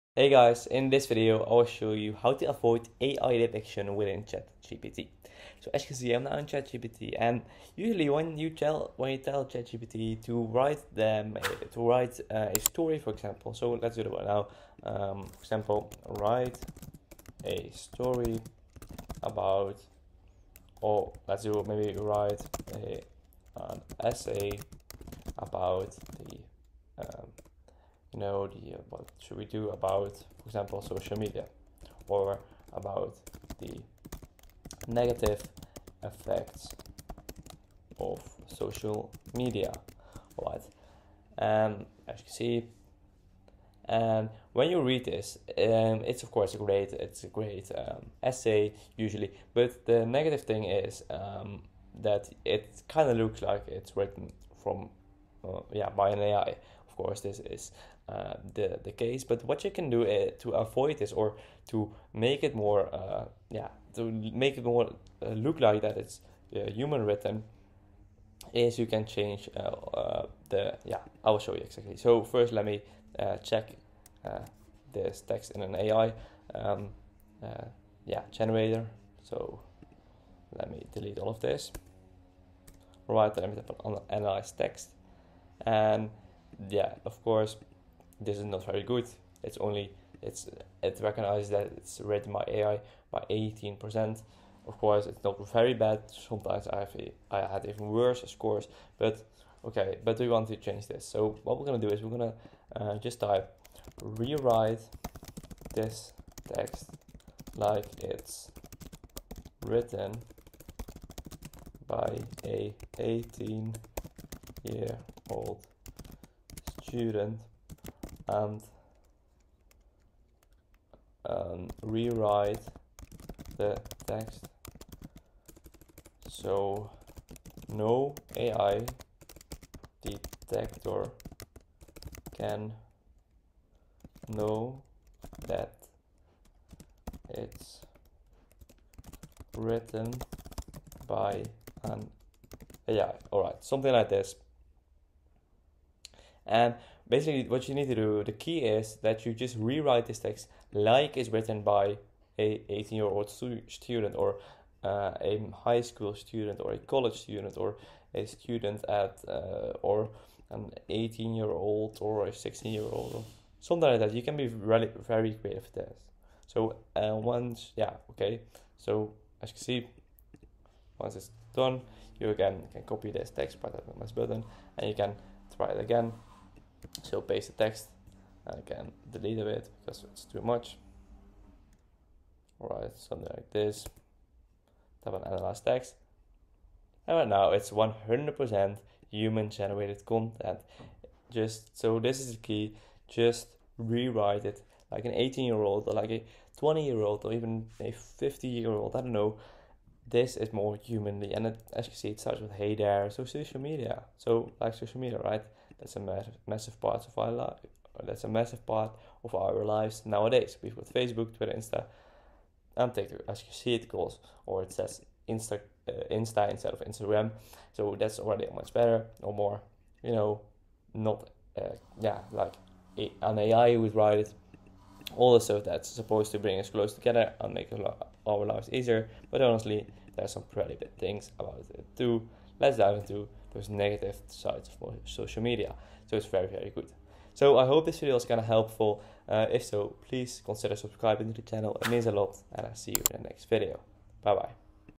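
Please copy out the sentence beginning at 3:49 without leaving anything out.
But honestly, there's some pretty bad things about it too let's dive into those negative sides of social media.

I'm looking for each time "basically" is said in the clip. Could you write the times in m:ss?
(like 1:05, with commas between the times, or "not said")
2:27.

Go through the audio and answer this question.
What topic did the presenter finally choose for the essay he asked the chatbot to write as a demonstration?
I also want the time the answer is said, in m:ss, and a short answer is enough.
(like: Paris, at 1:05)
Negative effects of social media, at 0:34.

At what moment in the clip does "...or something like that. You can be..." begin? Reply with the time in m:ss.
2:43.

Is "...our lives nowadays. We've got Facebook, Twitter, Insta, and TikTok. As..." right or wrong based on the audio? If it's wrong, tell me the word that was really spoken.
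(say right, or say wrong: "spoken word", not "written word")
right.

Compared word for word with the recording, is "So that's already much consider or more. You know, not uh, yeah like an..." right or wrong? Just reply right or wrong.
wrong.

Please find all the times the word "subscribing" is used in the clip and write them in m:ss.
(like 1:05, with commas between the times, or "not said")
4:00.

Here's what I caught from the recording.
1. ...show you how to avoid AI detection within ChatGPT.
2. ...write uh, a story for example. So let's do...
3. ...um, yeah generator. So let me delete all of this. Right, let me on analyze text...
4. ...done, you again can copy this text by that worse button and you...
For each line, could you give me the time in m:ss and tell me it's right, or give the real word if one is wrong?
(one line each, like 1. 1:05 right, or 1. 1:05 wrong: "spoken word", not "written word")
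1. 0:01 right
2. 0:11 right
3. 1:16 right
4. 2:51 wrong: "mouse", not "worse".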